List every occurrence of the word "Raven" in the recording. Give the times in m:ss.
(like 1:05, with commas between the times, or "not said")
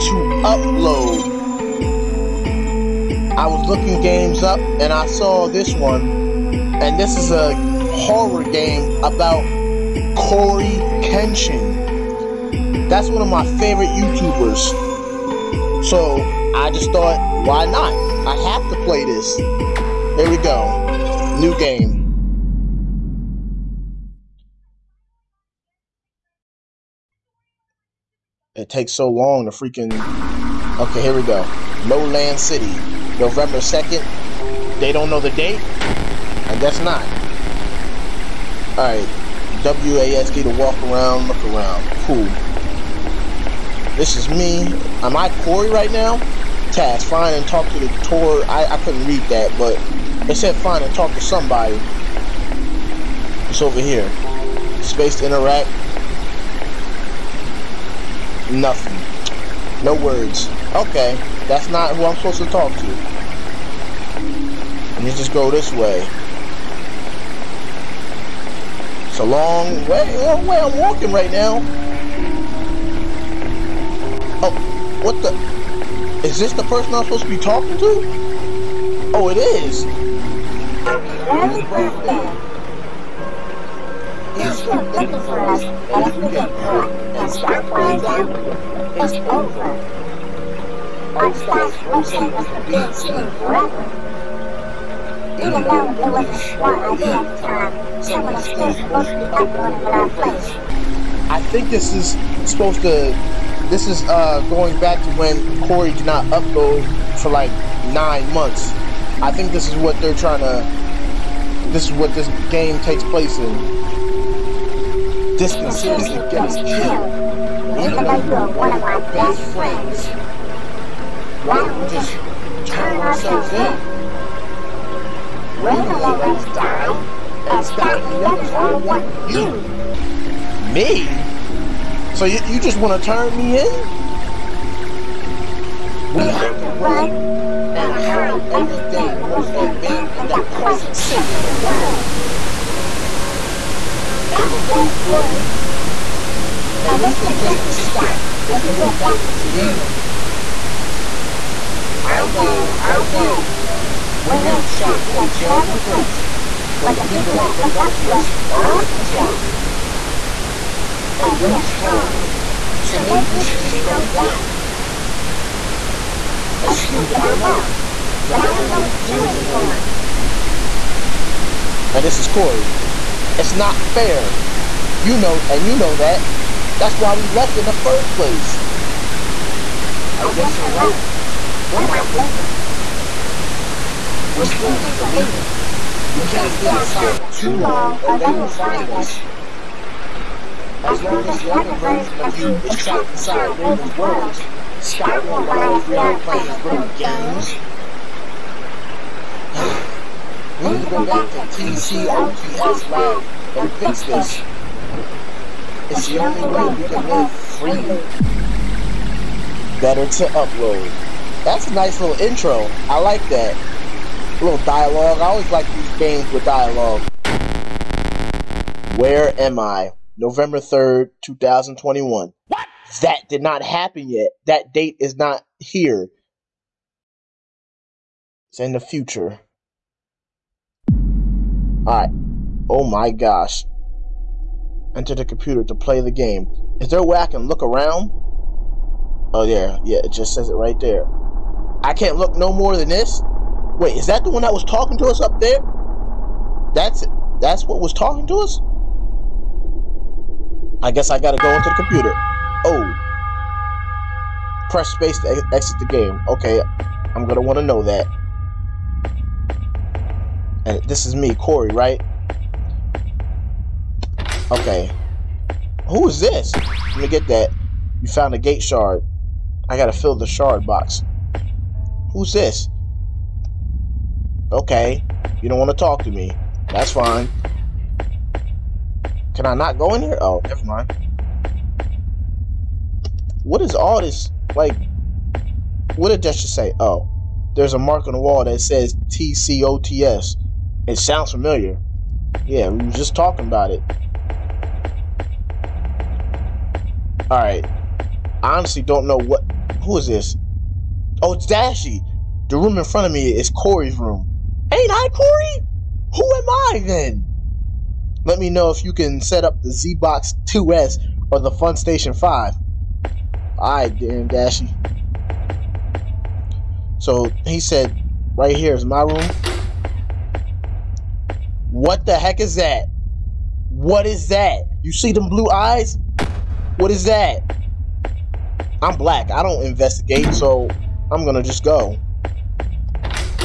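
3:13.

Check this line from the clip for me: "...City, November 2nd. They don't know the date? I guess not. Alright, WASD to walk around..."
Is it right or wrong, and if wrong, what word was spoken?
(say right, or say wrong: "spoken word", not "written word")
right.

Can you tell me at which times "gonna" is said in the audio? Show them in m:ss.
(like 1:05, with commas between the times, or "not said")
4:17, 5:31.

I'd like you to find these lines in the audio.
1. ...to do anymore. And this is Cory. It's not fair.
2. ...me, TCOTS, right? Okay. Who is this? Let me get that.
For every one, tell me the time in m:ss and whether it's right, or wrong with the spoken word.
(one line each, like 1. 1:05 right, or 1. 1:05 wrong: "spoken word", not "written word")
1. 2:48 right
2. 4:21 wrong: "Cory", not "TCOTS".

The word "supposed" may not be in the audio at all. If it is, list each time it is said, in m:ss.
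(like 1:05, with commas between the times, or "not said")
1:02, 1:38, 1:42.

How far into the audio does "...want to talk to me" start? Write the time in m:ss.
4:35.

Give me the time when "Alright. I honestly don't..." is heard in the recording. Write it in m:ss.
4:57.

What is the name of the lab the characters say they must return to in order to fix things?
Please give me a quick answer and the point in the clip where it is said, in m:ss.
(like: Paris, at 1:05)
TCOTS Lab, at 3:21.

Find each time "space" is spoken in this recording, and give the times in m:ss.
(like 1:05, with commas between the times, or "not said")
0:54, 4:14.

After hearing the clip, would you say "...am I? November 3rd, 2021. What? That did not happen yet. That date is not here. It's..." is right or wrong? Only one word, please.
right.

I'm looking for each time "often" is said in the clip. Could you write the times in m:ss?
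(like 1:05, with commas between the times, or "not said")
2:38.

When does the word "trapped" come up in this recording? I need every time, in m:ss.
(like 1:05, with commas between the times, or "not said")
2:39, 3:12.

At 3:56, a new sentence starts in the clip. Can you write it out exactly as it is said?
Is there a way I can look around?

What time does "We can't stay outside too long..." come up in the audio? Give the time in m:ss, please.
3:06.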